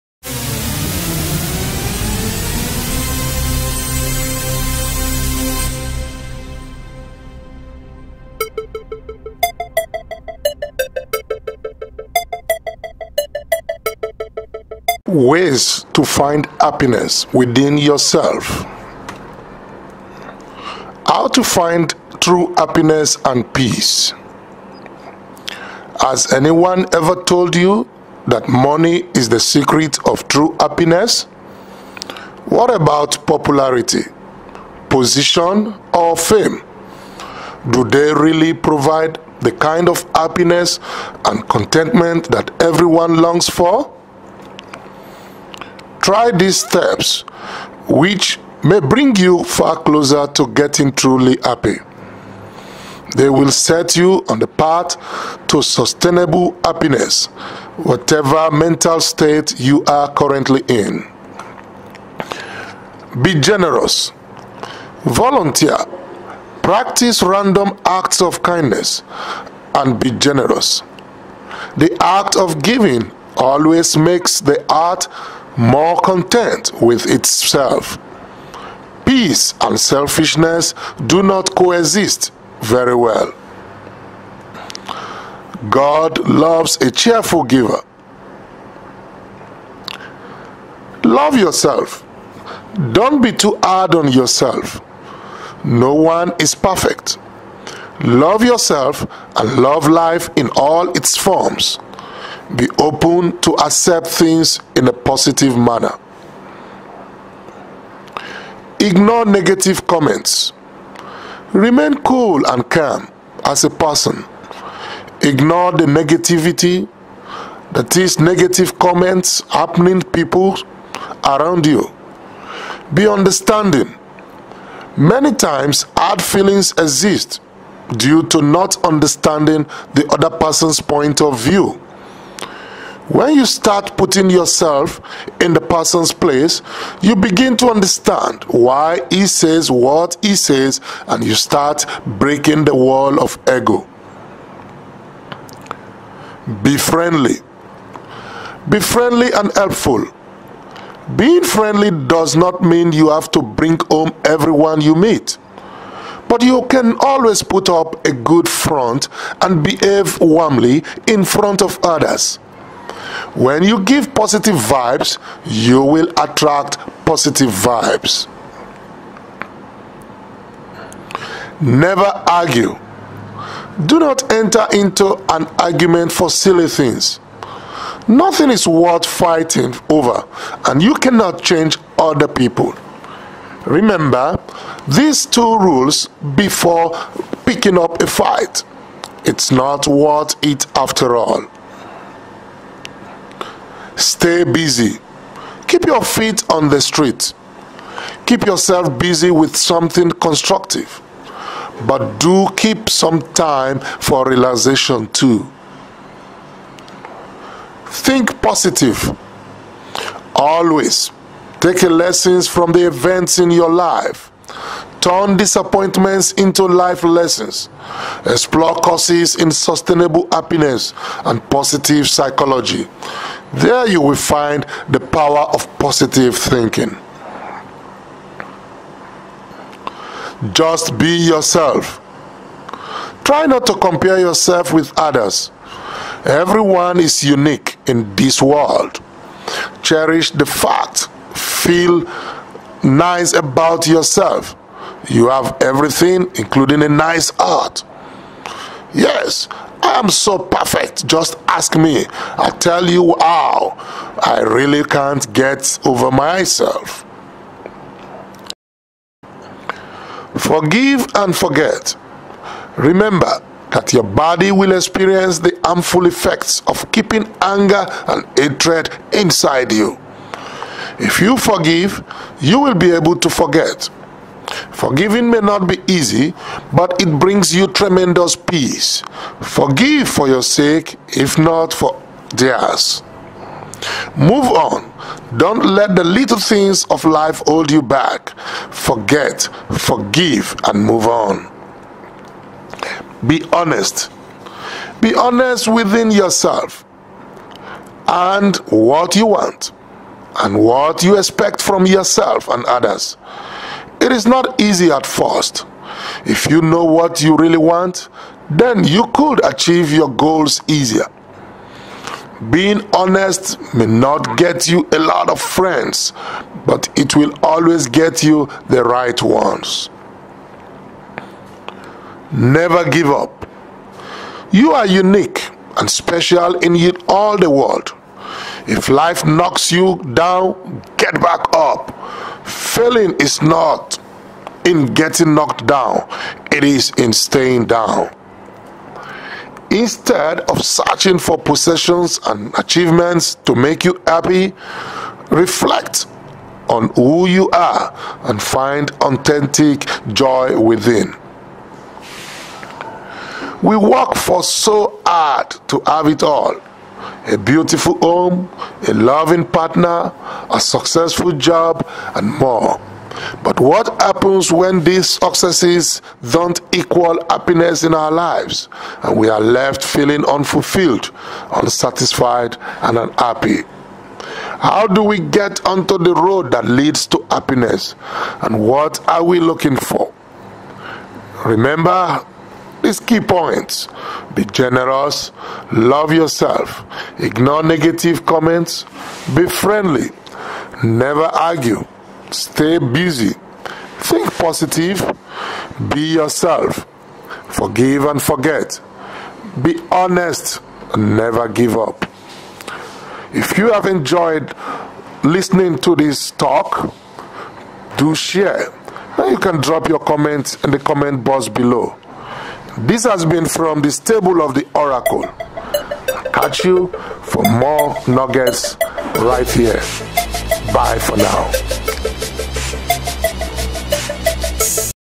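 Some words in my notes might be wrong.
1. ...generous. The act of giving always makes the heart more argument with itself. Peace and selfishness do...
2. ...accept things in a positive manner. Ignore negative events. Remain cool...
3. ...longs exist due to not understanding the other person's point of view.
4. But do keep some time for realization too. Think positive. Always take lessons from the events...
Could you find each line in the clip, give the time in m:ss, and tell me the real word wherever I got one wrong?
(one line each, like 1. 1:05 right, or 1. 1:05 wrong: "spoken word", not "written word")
1. 1:10 wrong: "content", not "argument"
2. 1:43 wrong: "comments", not "events"
3. 2:06 wrong: "feelings", not "longs"
4. 3:21 right.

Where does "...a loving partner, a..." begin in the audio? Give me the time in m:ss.
5:58.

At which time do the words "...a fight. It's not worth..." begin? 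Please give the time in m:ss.
3:08.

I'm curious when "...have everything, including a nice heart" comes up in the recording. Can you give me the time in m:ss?
4:05.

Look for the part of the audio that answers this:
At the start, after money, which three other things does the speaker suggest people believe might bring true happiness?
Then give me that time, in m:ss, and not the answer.
0:33.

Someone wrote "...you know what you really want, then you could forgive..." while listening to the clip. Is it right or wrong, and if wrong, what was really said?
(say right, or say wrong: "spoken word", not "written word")
wrong: "achieve", not "forgive".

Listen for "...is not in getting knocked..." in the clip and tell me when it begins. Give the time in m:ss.
5:33.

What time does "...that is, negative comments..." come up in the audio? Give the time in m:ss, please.
1:57.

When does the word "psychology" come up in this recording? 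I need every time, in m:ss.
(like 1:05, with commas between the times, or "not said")
3:42.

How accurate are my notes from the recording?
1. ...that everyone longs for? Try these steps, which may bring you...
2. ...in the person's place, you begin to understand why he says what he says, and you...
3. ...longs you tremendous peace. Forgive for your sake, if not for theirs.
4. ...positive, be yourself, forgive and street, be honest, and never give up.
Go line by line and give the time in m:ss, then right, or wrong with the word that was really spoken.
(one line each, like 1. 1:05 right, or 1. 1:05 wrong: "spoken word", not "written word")
1. 0:42 right
2. 2:15 right
3. 4:37 wrong: "brings", not "longs"
4. 6:34 wrong: "forget", not "street".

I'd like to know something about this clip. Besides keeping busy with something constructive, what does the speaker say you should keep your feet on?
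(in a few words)
The street.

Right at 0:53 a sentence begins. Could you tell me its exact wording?
They will set you on the path to sustainable happiness, whatever mental state you are currently in.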